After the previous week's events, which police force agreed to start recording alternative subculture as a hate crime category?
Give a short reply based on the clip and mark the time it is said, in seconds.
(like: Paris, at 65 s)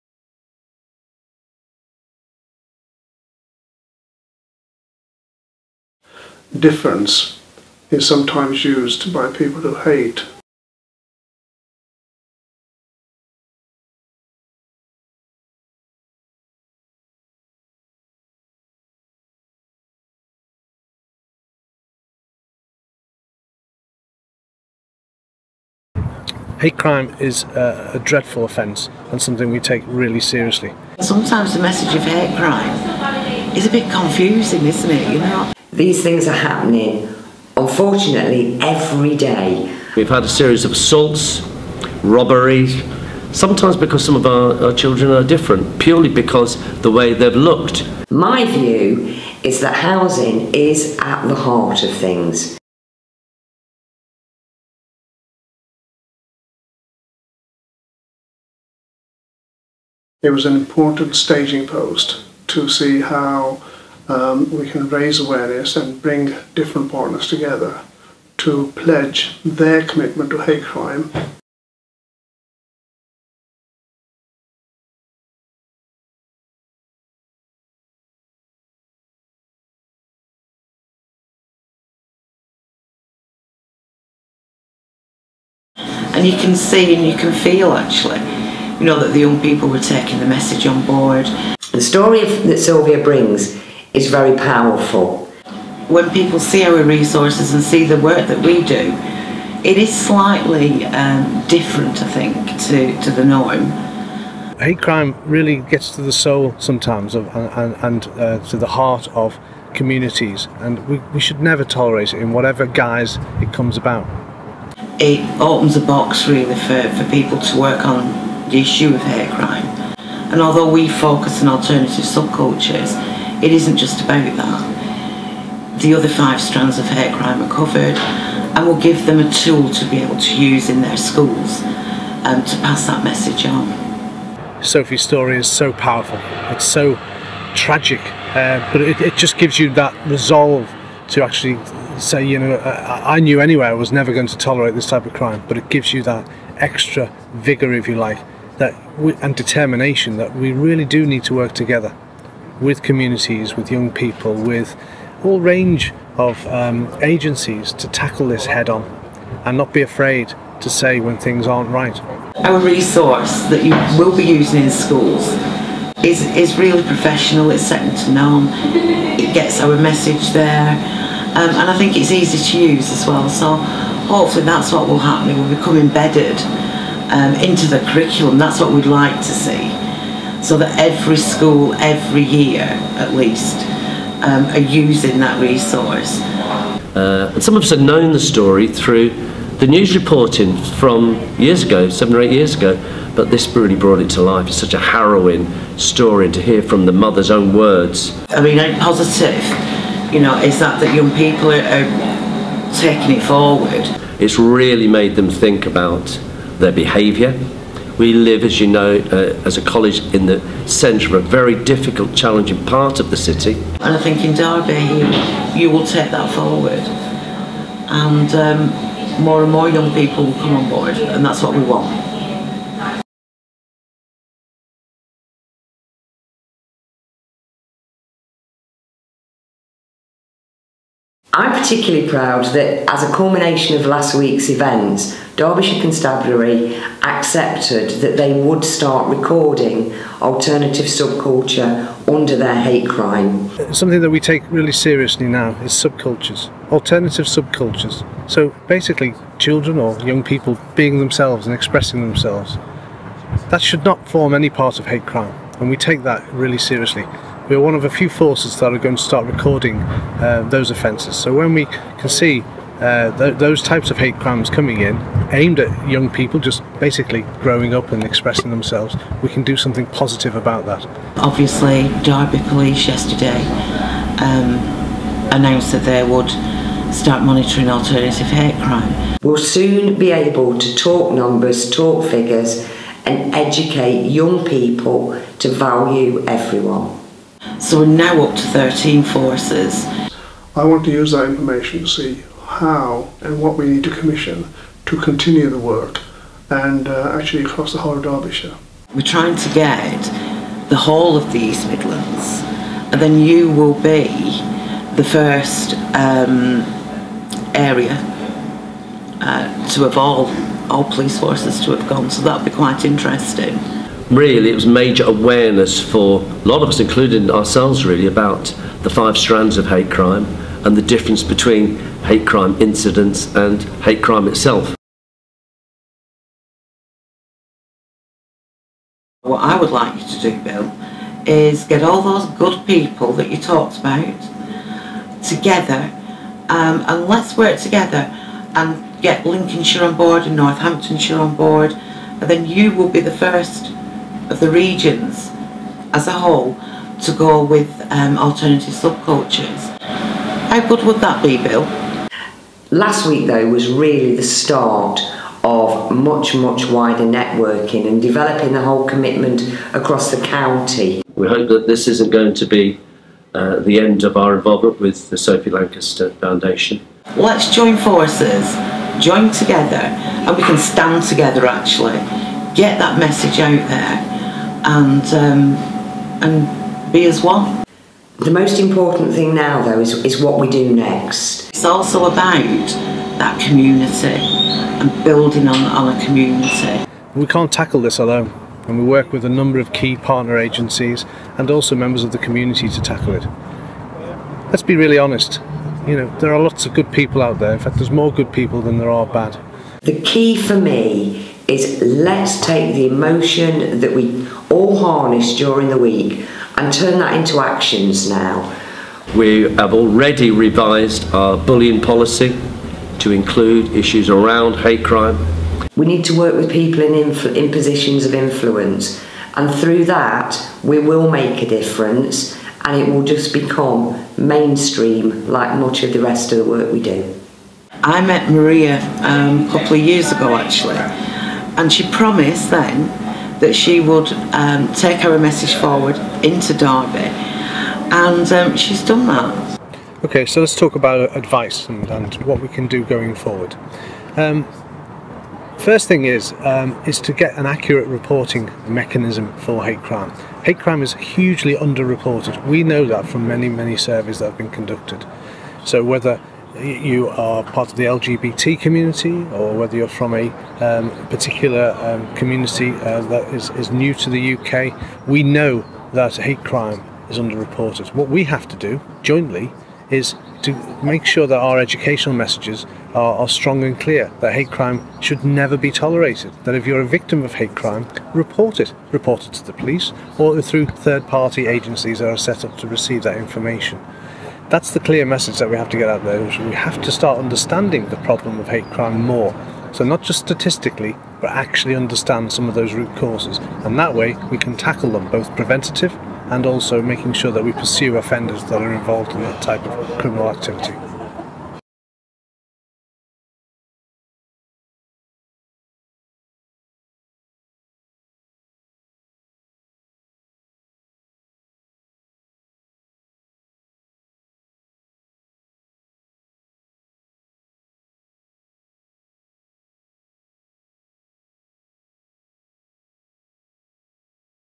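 Derbyshire Constabulary, at 235 s.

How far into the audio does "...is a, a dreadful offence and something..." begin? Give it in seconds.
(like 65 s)
27 s.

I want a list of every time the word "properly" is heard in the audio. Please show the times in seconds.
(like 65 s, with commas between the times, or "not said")
not said.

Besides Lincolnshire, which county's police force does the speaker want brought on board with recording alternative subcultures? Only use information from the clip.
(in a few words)
Northamptonshire.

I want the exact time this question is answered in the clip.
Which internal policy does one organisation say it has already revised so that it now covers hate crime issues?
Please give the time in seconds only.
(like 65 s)
411 s.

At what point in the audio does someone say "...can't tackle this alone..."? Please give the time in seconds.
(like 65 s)
387 s.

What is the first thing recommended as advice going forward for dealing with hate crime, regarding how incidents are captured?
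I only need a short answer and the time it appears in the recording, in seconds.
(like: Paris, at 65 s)
accurate reporting mechanism, at 447 s.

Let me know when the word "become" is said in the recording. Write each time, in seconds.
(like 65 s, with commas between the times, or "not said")
175 s, 423 s.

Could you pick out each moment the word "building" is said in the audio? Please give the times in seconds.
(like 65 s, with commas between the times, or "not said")
385 s.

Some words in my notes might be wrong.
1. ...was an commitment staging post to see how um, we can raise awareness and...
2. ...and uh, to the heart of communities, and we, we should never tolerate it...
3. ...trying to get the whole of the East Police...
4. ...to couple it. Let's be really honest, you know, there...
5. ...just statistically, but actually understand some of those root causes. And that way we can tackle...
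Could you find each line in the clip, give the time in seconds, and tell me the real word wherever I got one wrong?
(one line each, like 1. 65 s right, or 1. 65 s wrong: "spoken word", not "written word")
1. 60 s wrong: "important", not "commitment"
2. 107 s right
3. 299 s wrong: "Midlands", not "Police"
4. 392 s wrong: "tackle", not "couple"
5. 490 s right.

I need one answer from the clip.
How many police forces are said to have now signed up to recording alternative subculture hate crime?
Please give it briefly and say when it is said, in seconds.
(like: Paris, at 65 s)
13, at 288 s.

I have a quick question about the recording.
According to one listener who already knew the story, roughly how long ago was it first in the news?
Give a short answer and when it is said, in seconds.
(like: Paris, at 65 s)
7 or 8 years, at 191 s.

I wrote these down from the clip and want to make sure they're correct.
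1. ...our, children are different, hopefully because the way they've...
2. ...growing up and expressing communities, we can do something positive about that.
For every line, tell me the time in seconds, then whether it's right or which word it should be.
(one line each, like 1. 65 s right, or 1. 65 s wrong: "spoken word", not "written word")
1. 44 s wrong: "purely", not "hopefully"
2. 267 s wrong: "themselves", not "communities".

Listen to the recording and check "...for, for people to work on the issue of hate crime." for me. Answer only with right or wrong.
right.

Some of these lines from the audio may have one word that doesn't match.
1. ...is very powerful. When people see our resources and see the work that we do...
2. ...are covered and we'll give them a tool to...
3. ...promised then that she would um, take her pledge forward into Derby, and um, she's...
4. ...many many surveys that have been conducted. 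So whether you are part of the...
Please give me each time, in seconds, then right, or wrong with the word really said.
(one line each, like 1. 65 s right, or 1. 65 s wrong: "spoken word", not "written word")
1. 93 s right
2. 127 s right
3. 431 s wrong: "message", not "pledge"
4. 453 s right.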